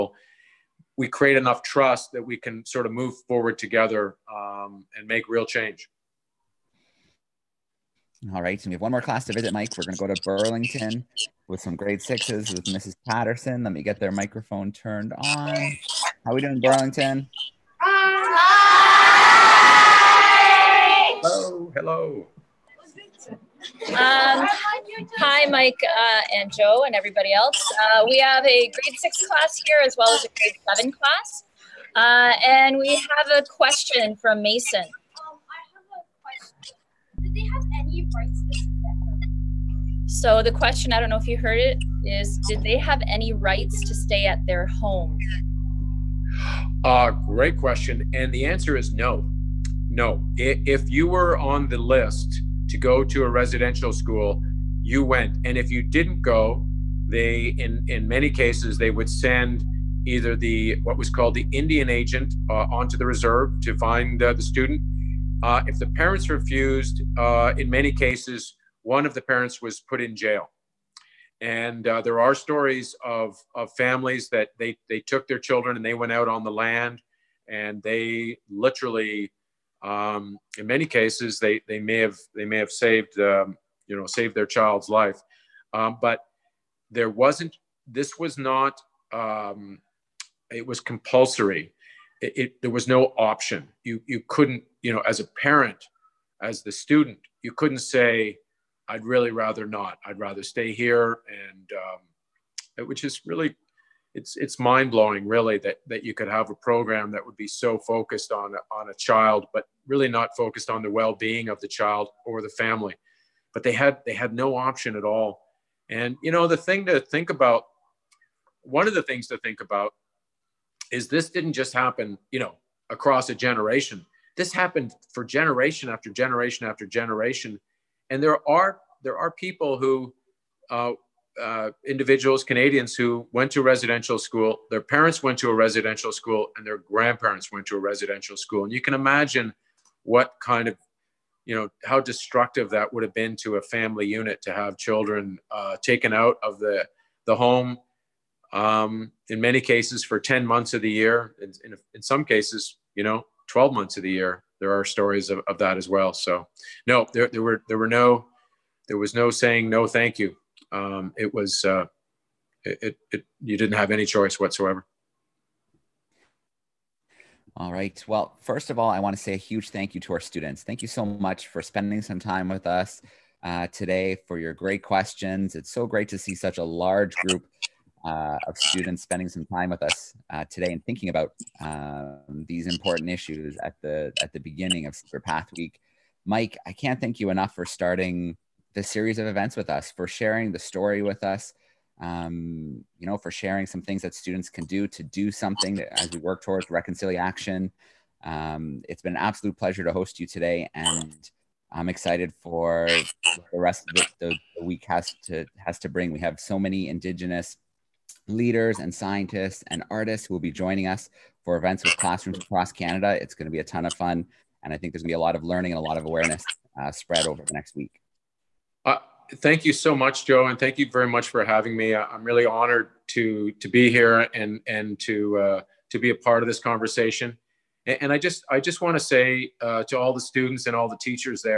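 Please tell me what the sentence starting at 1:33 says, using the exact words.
You you couldn't you know as a parent, as the student, you couldn't say I'd really rather not.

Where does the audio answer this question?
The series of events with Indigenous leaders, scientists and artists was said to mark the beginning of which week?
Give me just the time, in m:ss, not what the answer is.
3:04.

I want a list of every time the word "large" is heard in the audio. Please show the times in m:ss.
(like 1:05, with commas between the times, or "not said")
2:56.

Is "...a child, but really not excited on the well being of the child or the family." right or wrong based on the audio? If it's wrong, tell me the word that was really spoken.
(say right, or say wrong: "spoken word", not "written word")
wrong: "focused", not "excited".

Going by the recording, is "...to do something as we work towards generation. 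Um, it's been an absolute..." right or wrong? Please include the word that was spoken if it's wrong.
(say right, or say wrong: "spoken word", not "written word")
wrong: "reconciliation", not "generation".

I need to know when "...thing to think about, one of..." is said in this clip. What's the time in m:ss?
1:56.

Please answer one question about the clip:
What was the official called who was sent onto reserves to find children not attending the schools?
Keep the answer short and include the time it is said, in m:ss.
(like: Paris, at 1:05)
Indian agent, at 1:01.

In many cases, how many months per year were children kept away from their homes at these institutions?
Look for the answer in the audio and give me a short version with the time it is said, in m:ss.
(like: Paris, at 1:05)
10, at 2:30.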